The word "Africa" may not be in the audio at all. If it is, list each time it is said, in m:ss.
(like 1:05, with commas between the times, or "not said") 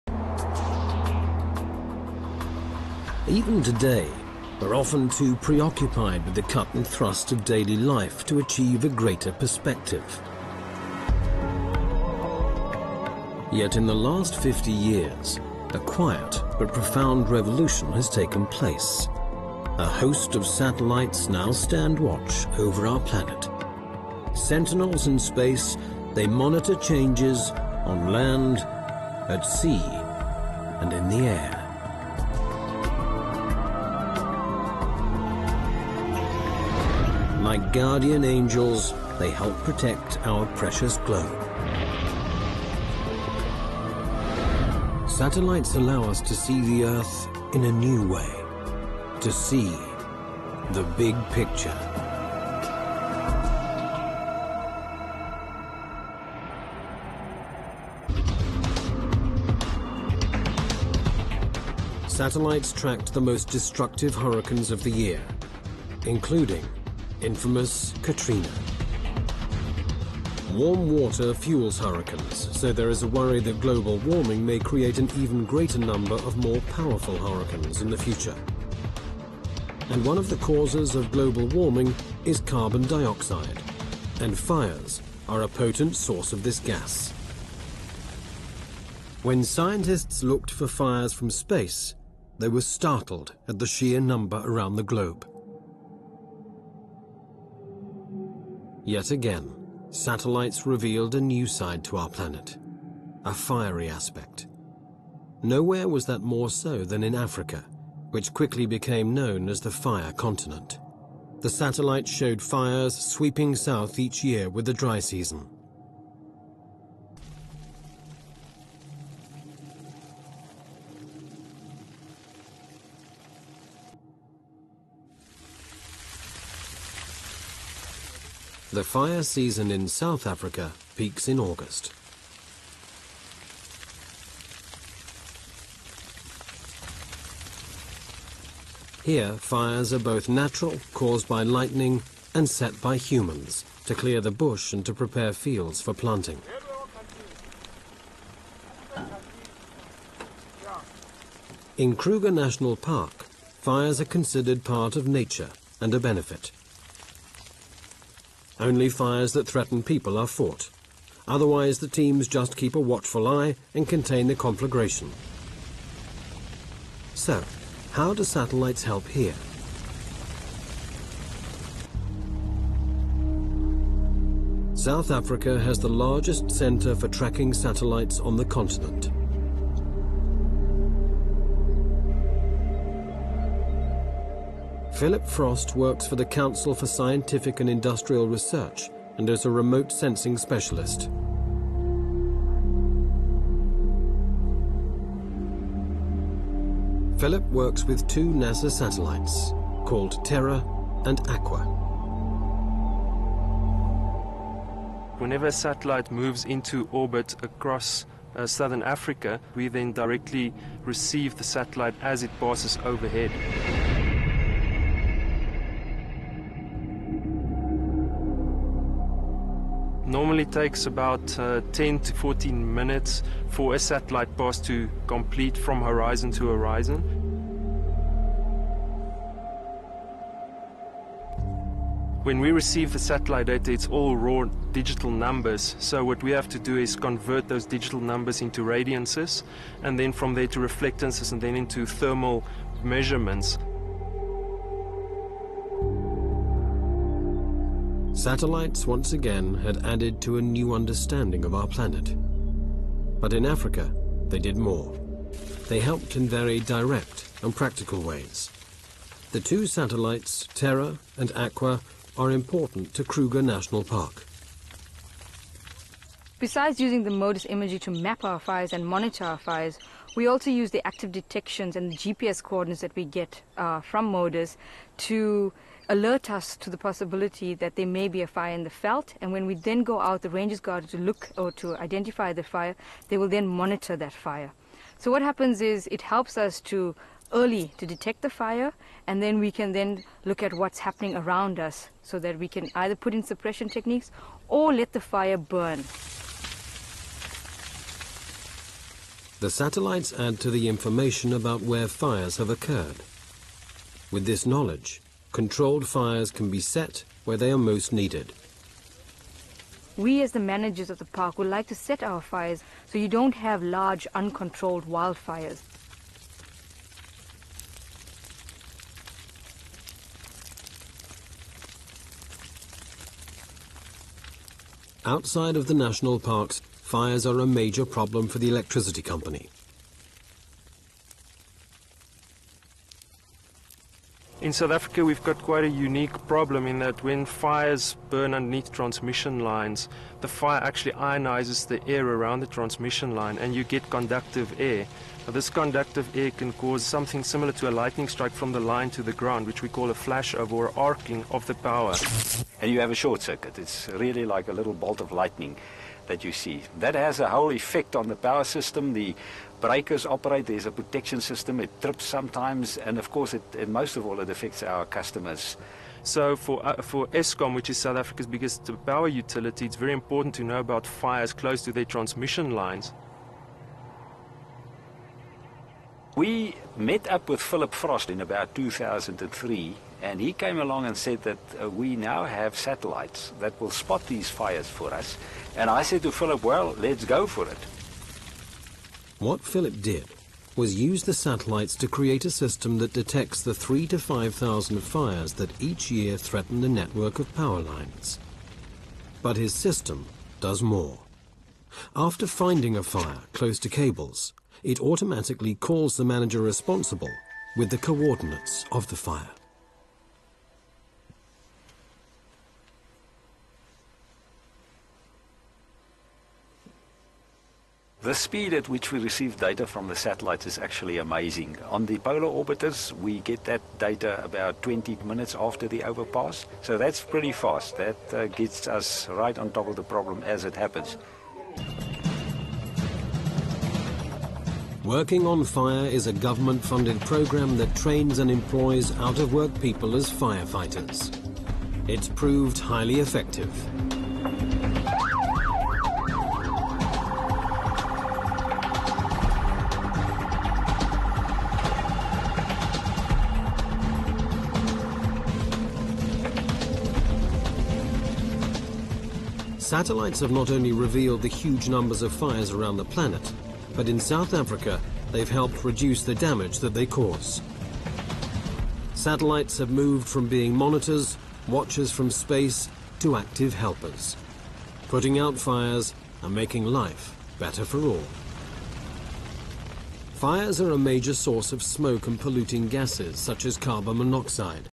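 1:47, 2:10, 2:55, 3:28, 4:13, 5:34, 6:08, 7:44.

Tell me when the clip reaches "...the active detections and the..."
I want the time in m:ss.
4:30.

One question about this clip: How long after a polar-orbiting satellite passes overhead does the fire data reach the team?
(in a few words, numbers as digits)
about 20 minutes.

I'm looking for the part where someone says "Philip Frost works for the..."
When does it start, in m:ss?
3:05.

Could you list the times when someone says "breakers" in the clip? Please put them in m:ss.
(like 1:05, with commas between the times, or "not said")
5:59.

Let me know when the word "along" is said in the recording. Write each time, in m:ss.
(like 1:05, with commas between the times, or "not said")
6:20.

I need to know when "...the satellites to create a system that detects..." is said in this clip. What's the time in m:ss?
6:31.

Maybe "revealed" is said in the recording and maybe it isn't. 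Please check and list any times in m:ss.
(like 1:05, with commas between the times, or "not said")
1:40, 7:40.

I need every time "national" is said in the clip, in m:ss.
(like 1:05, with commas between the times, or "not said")
2:32, 4:23, 5:25.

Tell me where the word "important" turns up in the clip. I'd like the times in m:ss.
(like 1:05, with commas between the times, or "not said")
4:22, 6:09.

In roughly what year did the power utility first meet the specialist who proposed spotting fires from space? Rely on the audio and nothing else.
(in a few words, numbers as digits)
2003.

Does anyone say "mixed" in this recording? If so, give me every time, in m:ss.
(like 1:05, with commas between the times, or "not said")
not said.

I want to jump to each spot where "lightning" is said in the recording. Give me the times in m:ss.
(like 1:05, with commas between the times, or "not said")
2:21, 5:47, 5:55.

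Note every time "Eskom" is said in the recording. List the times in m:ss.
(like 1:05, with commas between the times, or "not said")
6:07.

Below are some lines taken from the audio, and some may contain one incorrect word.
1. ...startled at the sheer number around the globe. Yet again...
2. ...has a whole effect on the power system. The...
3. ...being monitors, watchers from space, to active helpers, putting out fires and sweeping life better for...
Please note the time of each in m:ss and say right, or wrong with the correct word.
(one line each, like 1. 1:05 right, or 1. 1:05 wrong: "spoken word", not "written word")
1. 1:32 right
2. 5:56 right
3. 7:50 wrong: "making", not "sweeping".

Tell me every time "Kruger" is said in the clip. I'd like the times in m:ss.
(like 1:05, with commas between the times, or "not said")
2:31, 4:23.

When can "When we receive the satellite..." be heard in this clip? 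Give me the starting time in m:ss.
3:52.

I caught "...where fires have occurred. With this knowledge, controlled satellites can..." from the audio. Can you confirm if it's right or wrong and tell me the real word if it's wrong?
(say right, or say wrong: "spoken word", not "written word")
wrong: "fires", not "satellites".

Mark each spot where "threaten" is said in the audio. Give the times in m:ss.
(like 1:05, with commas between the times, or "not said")
2:39, 6:36.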